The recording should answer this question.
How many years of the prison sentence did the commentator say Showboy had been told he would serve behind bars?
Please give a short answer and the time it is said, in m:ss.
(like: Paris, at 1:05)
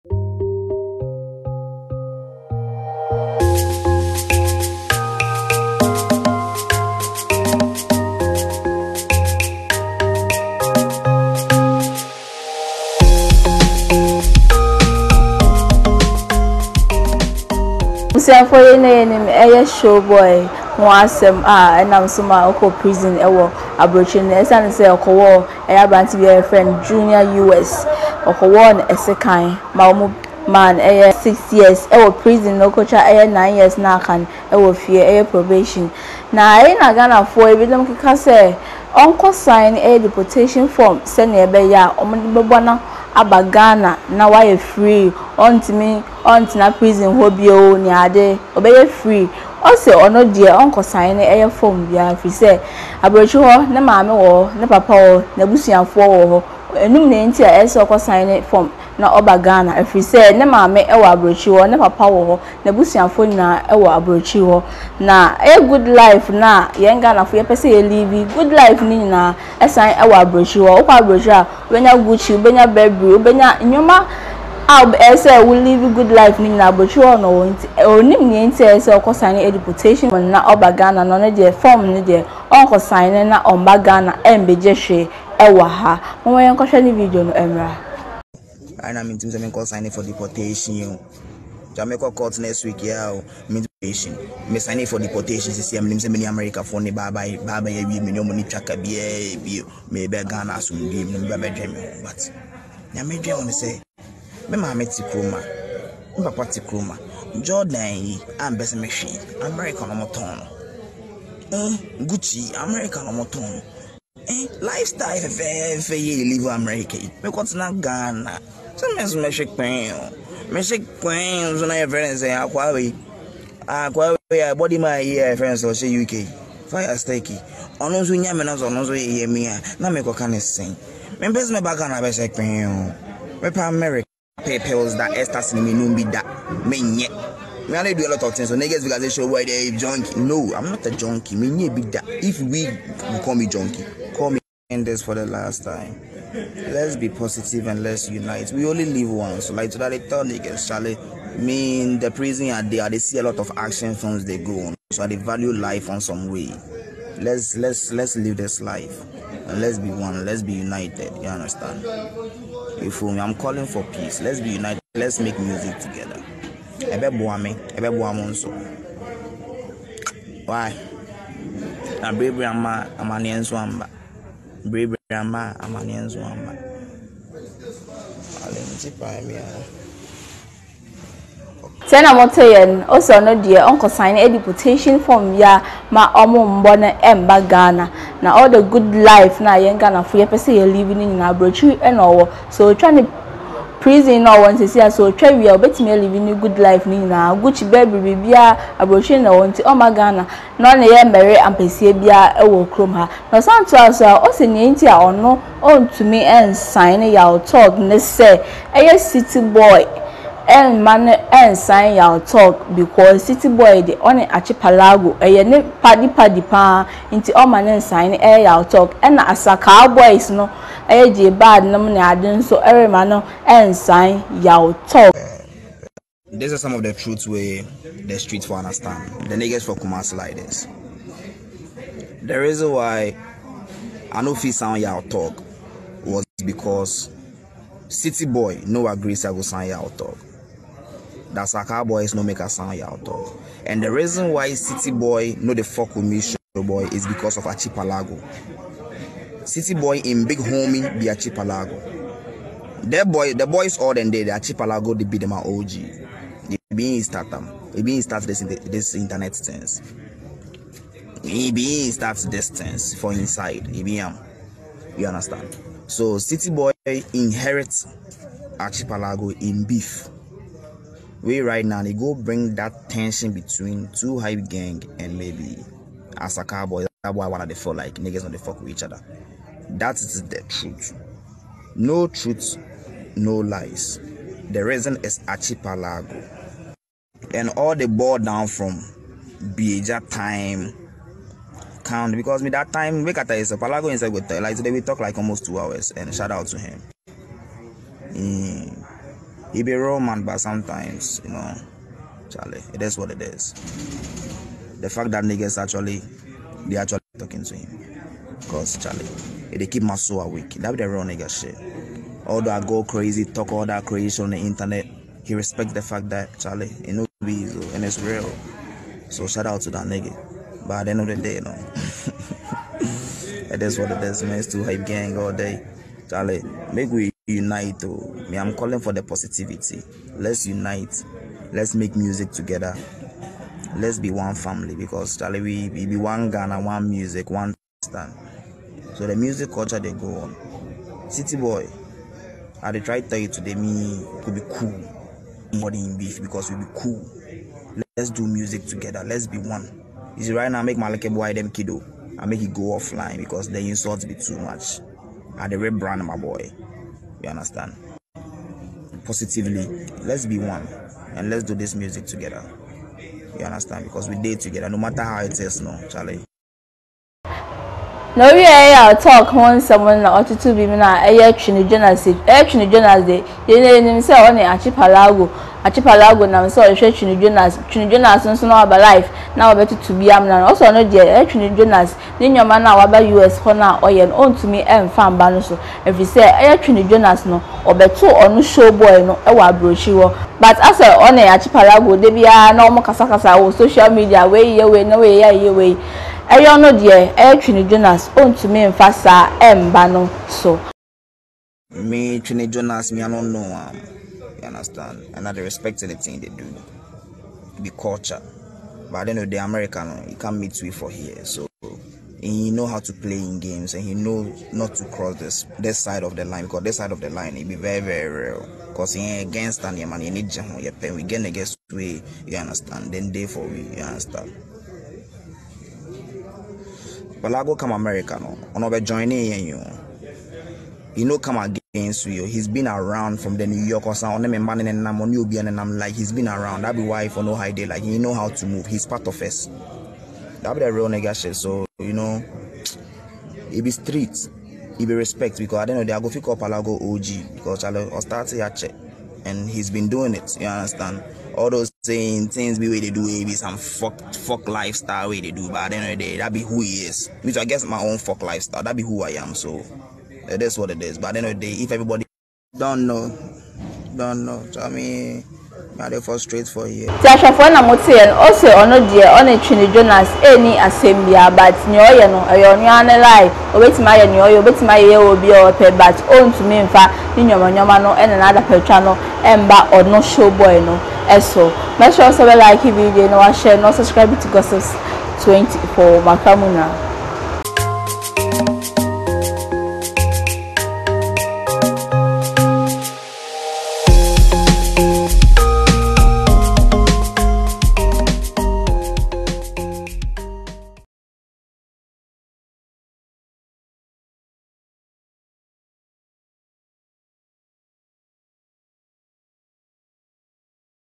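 6 years, at 0:31.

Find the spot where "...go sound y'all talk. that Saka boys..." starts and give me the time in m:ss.
3:59.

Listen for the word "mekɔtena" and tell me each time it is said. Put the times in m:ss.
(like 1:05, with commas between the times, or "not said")
1:57.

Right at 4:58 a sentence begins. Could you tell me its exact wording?
Mm he be real man, but sometimes, you know, Charlie, it is what it is.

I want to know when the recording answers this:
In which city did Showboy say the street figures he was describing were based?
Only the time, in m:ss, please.
3:49.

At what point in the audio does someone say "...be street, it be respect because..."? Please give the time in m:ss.
7:23.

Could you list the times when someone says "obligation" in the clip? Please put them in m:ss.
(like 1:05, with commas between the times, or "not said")
not said.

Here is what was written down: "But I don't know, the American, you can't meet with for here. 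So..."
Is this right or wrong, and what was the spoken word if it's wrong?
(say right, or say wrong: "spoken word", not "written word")
right.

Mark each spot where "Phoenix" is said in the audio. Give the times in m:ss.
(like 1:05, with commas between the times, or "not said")
not said.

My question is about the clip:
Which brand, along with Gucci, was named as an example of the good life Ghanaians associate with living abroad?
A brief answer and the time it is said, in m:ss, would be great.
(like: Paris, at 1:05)
Burberry, at 1:12.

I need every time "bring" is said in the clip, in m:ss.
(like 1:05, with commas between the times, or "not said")
4:32.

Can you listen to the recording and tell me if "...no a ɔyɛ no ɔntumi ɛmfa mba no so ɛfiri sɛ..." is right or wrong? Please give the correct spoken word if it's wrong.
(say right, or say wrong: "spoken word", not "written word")
right.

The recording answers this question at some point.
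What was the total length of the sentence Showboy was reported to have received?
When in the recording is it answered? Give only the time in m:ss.
0:33.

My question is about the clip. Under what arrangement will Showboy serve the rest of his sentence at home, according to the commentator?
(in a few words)
Probation.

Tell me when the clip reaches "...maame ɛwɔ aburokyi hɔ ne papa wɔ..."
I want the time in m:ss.
1:00.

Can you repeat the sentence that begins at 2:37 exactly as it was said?
Let's let's let's live this life.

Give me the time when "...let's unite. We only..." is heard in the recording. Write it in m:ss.
2:27.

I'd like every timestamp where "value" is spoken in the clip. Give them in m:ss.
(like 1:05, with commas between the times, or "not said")
2:35.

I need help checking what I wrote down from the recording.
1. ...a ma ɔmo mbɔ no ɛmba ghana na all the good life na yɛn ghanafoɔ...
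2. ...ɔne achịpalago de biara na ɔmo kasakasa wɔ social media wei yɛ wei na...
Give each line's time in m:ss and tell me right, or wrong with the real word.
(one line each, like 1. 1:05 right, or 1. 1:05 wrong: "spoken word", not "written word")
1. 3:05 right
2. 6:30 right.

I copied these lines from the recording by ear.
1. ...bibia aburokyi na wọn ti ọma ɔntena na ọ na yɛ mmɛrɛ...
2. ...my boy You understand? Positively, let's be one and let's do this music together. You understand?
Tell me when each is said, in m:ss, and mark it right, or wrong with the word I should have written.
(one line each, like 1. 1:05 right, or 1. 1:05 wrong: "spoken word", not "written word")
1. 3:18 wrong: "ghana", not "ɔntena"
2. 5:56 right.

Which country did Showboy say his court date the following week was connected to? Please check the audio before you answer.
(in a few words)
Jamaica.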